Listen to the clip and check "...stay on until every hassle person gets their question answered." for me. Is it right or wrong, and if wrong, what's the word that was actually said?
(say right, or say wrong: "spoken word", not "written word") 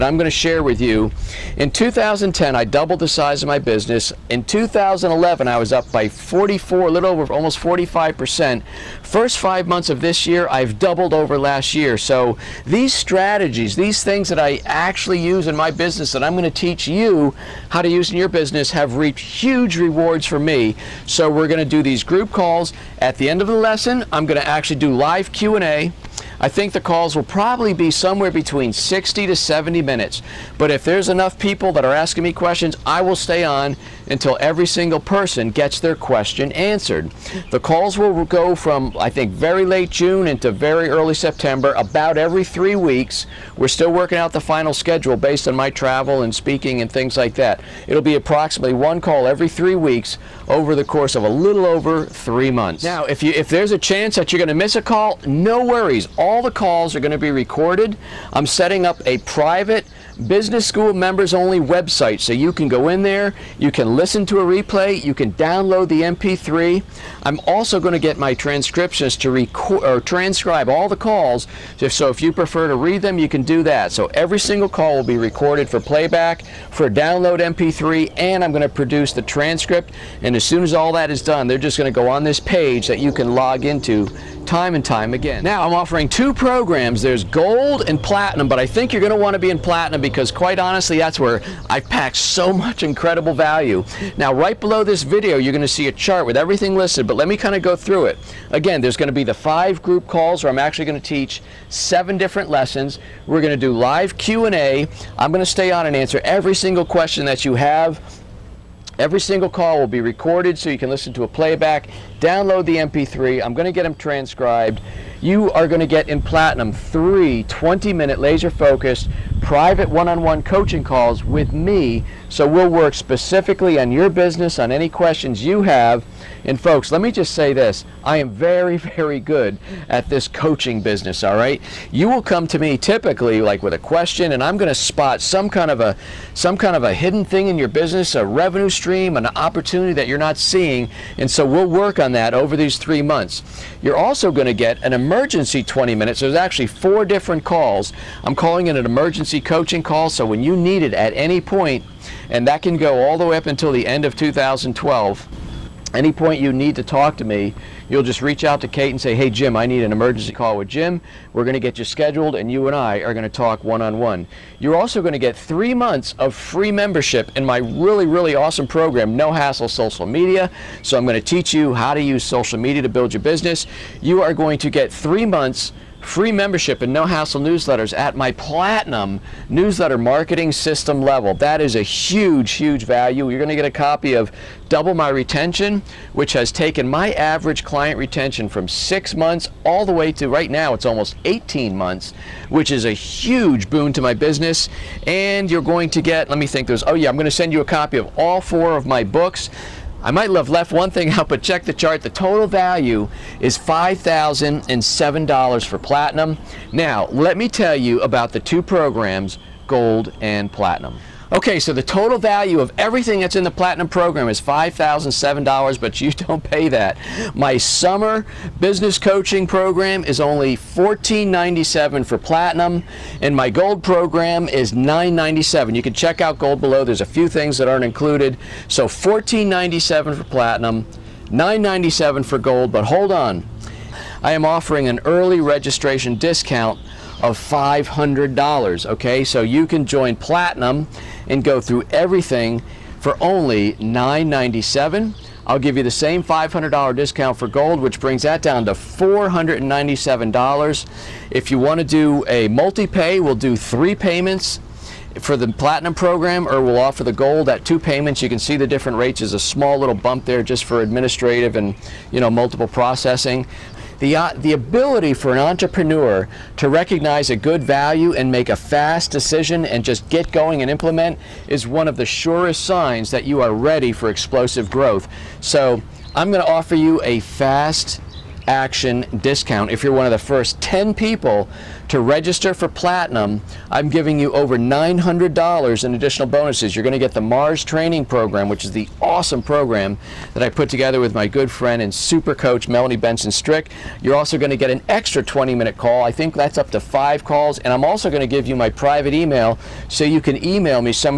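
wrong: "single", not "hassle".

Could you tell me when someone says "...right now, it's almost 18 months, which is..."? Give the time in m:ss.
3:10.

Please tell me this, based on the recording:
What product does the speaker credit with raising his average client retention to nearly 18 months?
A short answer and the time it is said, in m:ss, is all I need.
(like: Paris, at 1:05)
Double My Retention, at 3:04.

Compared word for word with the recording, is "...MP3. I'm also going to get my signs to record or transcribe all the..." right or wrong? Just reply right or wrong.
wrong.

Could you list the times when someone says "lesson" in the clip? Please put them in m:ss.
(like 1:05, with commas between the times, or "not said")
0:23, 1:42.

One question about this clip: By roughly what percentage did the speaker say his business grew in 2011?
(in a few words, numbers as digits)
44%.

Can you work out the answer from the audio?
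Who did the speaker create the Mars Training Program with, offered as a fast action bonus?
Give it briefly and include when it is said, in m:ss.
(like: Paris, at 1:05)
Melanie Benson Strick, at 4:52.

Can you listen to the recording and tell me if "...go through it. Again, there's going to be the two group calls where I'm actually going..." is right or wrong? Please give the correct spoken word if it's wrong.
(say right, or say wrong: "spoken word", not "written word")
wrong: "five", not "two".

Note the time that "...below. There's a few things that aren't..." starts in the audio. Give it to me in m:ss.
3:46.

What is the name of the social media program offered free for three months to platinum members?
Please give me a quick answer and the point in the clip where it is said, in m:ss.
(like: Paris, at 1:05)
No Hassle Social Media, at 2:49.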